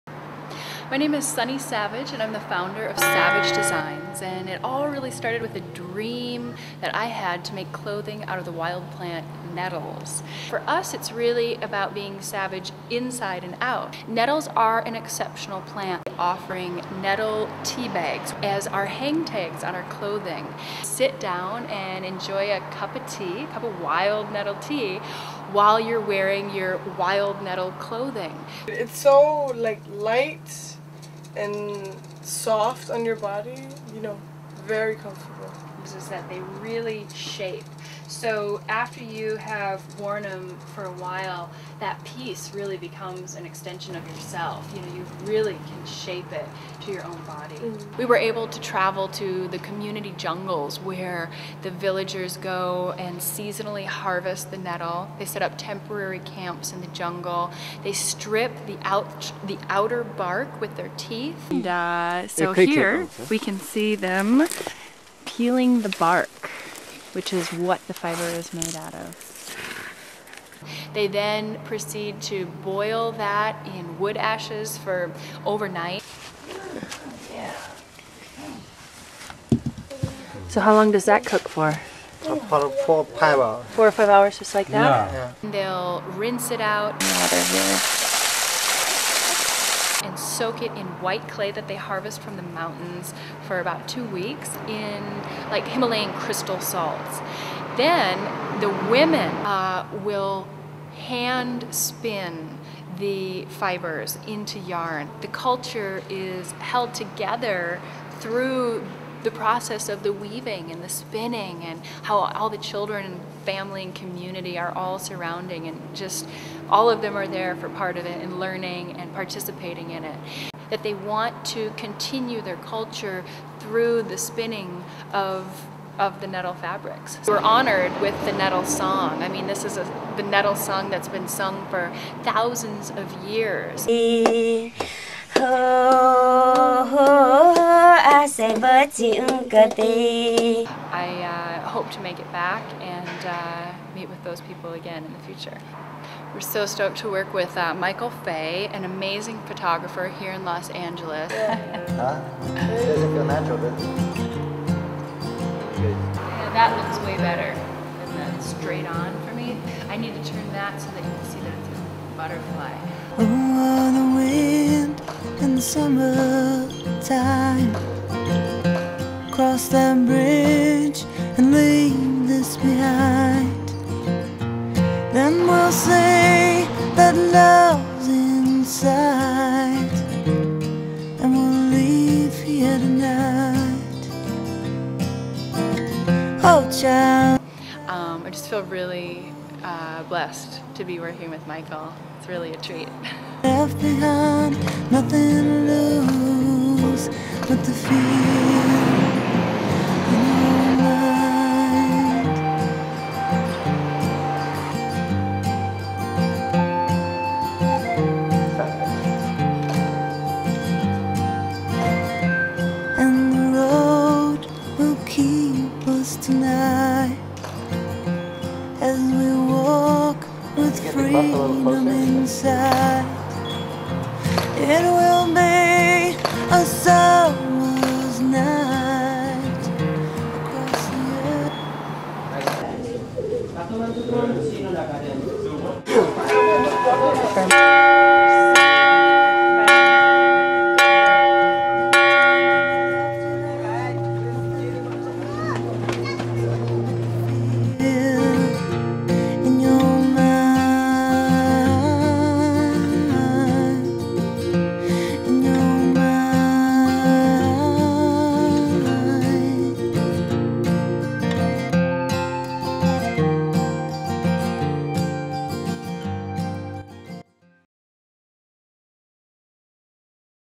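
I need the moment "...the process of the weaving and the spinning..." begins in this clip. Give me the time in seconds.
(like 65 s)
109 s.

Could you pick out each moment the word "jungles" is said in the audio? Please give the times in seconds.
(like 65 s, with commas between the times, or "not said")
50 s, 56 s.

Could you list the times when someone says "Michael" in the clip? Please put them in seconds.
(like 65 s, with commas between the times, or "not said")
147 s, 191 s.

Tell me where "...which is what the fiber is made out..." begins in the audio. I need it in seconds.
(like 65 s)
67 s.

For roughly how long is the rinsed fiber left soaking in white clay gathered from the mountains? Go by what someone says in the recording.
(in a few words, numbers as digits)
2 weeks.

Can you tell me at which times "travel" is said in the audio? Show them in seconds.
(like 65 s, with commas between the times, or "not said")
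48 s.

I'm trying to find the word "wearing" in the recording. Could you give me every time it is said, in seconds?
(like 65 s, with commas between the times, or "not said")
26 s.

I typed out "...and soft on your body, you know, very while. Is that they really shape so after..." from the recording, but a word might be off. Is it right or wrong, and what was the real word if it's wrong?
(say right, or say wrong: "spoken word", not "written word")
wrong: "comfortable", not "while".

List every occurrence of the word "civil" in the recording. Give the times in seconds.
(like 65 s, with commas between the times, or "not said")
not said.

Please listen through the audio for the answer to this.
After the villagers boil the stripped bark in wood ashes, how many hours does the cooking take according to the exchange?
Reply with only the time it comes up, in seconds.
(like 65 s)
82 s.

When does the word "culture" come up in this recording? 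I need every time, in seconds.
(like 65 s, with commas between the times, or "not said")
105 s, 122 s.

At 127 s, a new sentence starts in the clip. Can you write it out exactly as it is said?
We're honored with the nettle song.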